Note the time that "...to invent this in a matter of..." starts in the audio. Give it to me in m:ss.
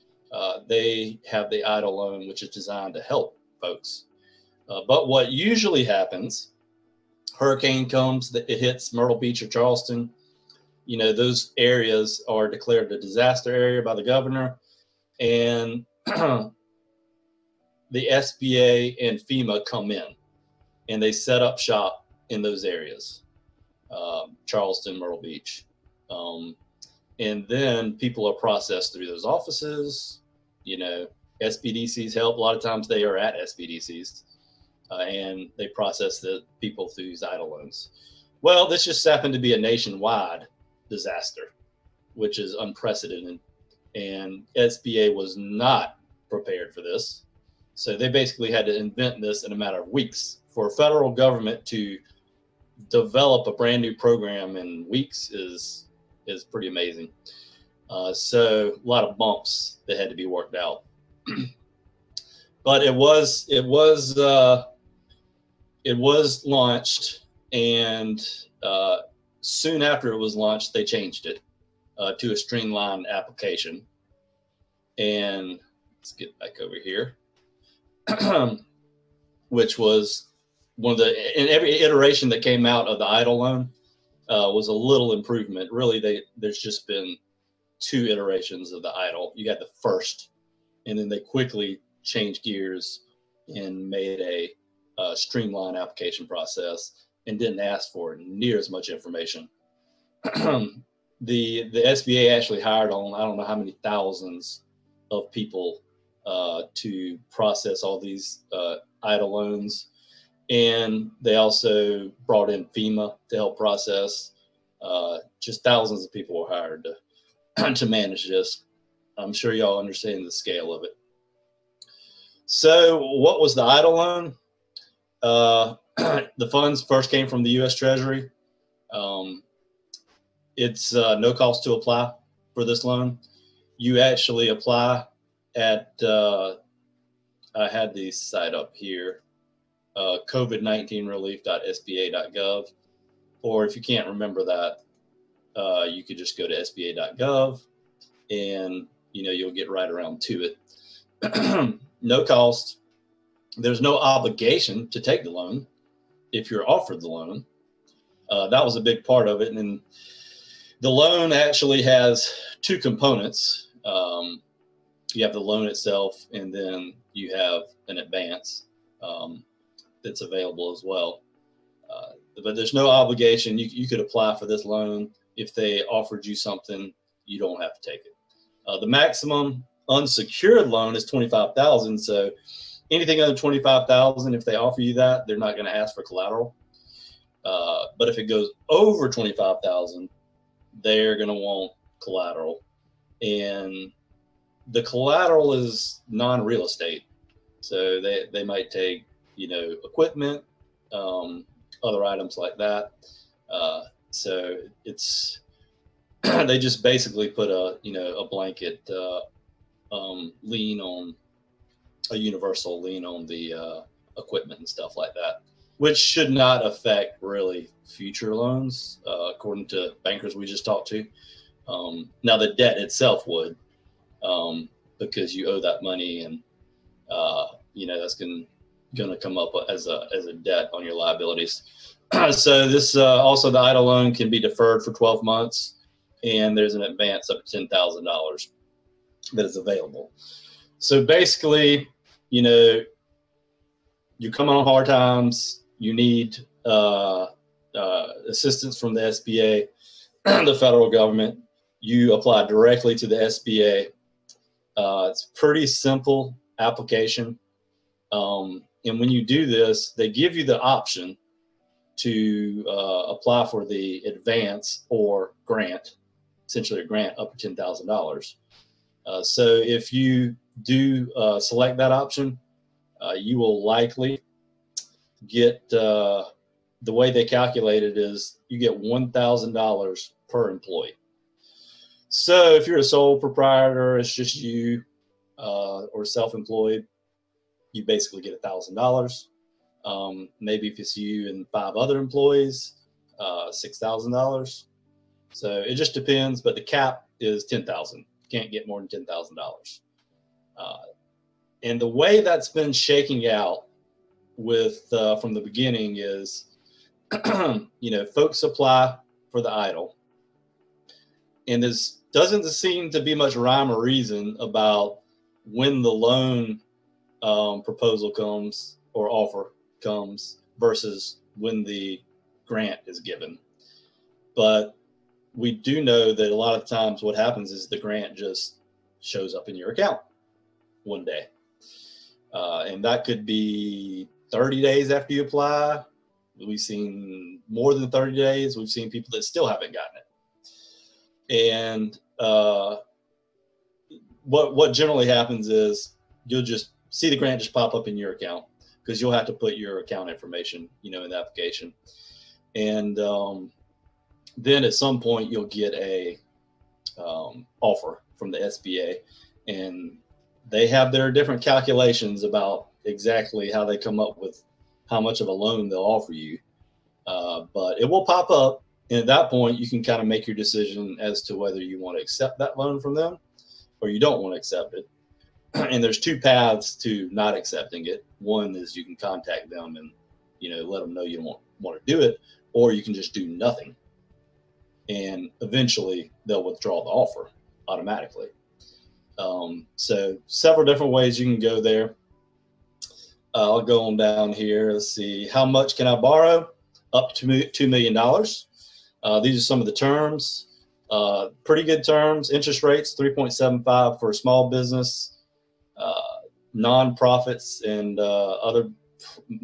0:48.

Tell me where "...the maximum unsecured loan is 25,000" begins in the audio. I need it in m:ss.
2:58.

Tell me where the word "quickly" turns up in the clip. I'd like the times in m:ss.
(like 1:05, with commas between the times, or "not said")
1:31.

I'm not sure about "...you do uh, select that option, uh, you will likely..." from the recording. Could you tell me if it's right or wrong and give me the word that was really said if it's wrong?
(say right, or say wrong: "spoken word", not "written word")
right.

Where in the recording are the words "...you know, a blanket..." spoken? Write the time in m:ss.
3:27.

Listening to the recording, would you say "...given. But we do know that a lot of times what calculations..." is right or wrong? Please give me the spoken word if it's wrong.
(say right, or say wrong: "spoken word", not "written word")
wrong: "happens", not "calculations".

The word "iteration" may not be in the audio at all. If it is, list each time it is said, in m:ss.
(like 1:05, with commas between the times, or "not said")
1:21, 1:28.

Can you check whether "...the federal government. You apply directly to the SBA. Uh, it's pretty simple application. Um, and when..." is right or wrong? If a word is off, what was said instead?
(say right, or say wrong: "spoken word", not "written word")
right.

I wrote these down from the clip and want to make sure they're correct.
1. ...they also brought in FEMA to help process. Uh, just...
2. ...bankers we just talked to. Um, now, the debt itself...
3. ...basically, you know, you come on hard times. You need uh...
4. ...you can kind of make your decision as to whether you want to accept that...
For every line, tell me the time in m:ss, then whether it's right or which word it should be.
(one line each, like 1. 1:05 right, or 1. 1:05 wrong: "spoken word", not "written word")
1. 1:51 right
2. 3:40 right
3. 4:01 right
4. 6:09 right.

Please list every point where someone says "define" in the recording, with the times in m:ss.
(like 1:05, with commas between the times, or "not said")
not said.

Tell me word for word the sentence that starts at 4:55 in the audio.
So it just depends, but the cap is 10,000.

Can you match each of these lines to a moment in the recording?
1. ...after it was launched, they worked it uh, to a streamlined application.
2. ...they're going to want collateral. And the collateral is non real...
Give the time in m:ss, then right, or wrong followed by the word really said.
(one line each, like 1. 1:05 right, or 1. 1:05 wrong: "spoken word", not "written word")
1. 1:09 wrong: "changed", not "worked"
2. 3:10 right.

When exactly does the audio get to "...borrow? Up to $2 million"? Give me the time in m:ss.
6:35.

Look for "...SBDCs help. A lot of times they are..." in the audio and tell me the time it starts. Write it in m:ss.
0:31.